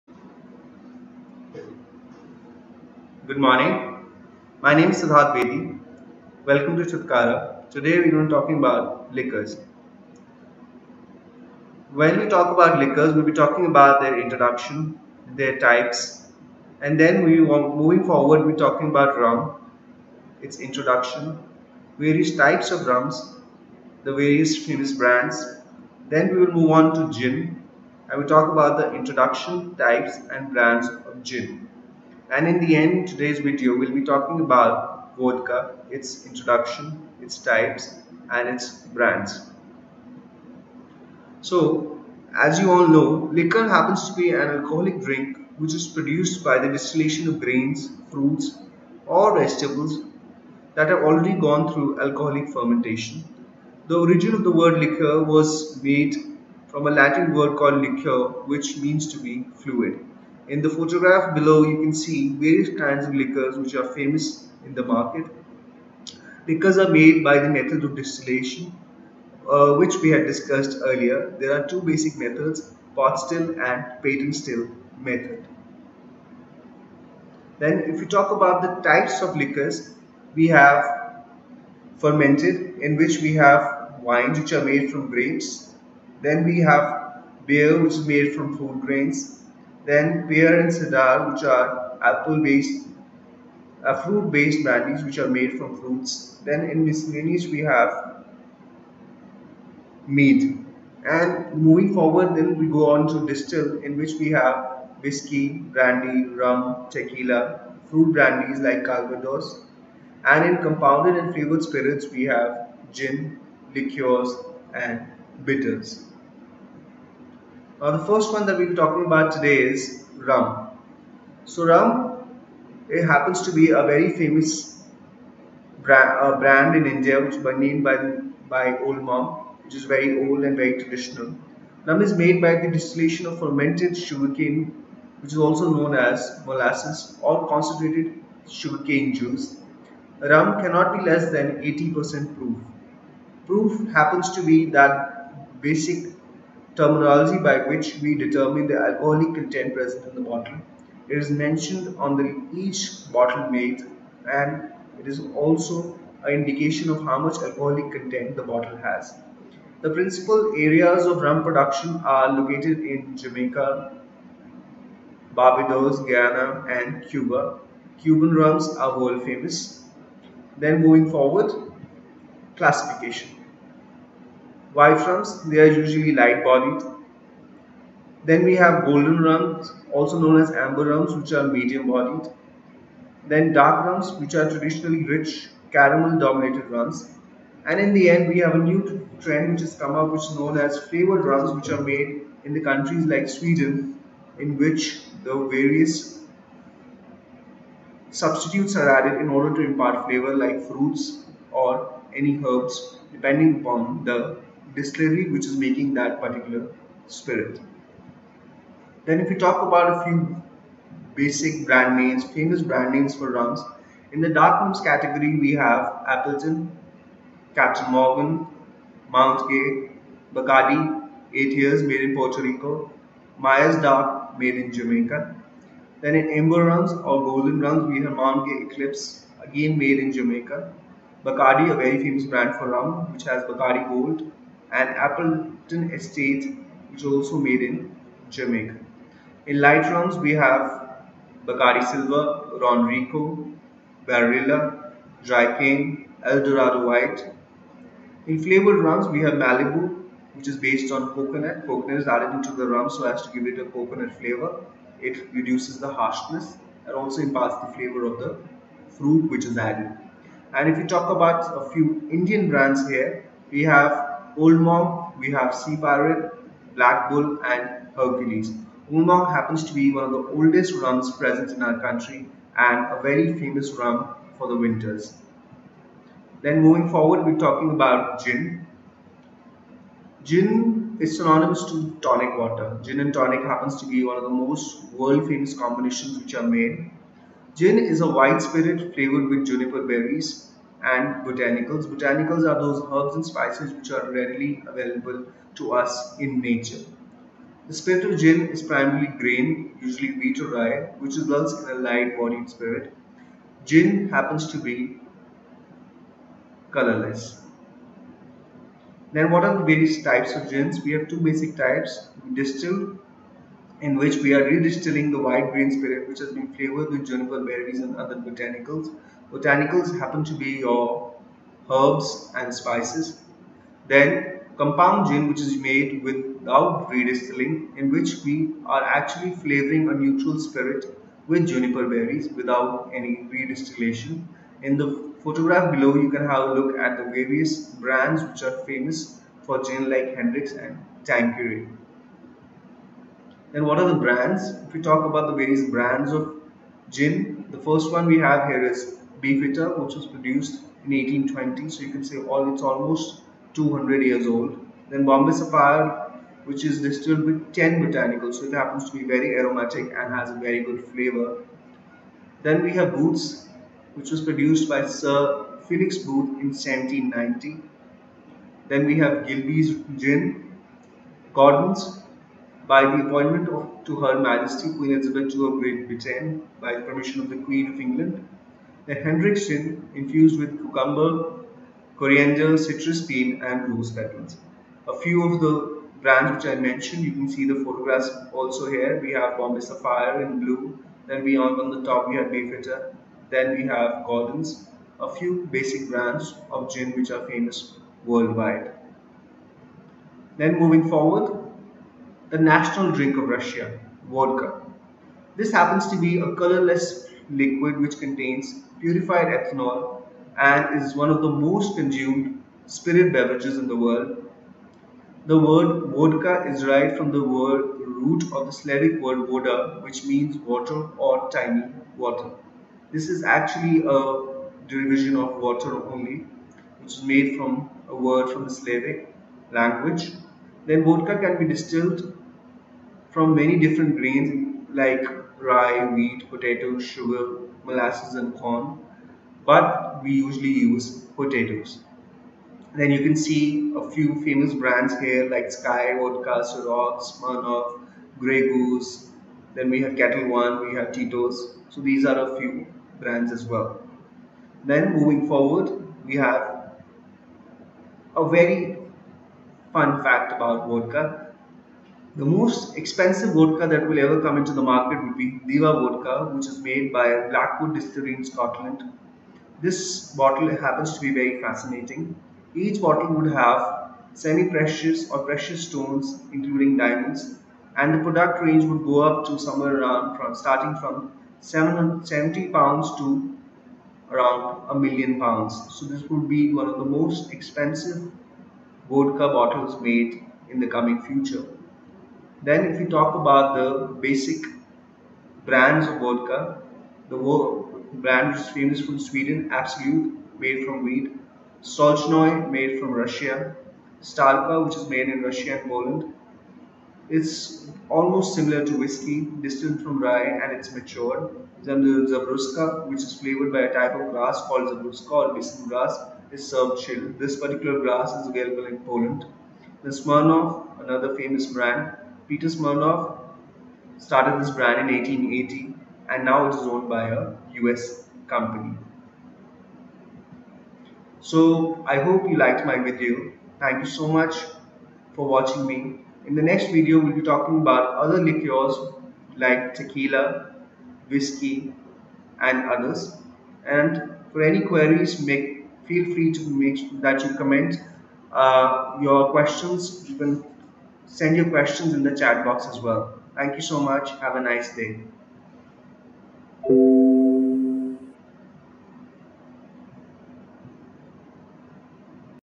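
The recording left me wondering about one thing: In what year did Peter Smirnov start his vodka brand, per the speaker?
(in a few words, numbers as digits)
1880.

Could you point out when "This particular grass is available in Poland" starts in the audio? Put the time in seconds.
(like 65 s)
517 s.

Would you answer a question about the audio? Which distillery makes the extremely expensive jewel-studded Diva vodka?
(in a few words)
Blackwood Distillery.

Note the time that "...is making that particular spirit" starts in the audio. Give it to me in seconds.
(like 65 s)
205 s.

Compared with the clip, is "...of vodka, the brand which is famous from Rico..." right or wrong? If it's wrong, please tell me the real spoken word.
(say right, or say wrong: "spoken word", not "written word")
wrong: "Sweden", not "Rico".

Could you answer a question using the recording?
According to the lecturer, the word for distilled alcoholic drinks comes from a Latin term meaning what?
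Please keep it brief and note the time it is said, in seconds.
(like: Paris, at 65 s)
to be fluid, at 59 s.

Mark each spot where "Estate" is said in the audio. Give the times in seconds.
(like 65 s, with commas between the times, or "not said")
235 s.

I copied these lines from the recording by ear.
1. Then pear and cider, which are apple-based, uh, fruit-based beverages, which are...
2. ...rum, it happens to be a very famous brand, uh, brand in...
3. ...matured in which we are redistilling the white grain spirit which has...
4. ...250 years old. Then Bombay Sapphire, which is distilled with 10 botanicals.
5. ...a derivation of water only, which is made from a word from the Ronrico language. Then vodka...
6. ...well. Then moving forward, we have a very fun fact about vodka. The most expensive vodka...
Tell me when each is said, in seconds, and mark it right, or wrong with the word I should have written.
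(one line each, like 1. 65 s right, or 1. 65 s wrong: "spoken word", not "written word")
1. 89 s wrong: "brandies", not "beverages"
2. 121 s right
3. 312 s wrong: "distilled", not "matured"
4. 353 s wrong: "200", not "250"
5. 423 s wrong: "Slavic", not "Ronrico"
6. 453 s right.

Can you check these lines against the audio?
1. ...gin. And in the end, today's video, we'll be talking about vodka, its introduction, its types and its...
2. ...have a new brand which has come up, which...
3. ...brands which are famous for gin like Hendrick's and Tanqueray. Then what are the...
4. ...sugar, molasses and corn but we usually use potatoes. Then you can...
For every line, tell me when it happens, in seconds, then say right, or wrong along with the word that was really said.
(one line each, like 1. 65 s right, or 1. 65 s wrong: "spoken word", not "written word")
1. 31 s right
2. 188 s wrong: "trend", not "brand"
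3. 337 s right
4. 436 s right.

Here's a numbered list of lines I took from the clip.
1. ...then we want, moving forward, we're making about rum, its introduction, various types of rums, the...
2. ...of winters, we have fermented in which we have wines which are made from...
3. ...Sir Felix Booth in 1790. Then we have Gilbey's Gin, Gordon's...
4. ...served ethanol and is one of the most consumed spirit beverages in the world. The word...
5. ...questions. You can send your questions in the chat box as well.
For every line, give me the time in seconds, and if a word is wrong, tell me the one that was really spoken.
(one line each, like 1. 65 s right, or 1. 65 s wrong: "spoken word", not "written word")
1. 16 s wrong: "talking", not "making"
2. 79 s wrong: "liquors", not "winters"
3. 364 s right
4. 408 s wrong: "purified", not "served"
5. 549 s right.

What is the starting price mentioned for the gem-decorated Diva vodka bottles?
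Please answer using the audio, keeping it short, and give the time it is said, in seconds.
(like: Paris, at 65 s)
770 pounds, at 481 s.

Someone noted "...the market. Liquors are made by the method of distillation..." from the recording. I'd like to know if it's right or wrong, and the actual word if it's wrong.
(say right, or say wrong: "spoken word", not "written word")
right.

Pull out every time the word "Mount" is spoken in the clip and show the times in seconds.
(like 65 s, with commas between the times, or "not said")
219 s, 228 s.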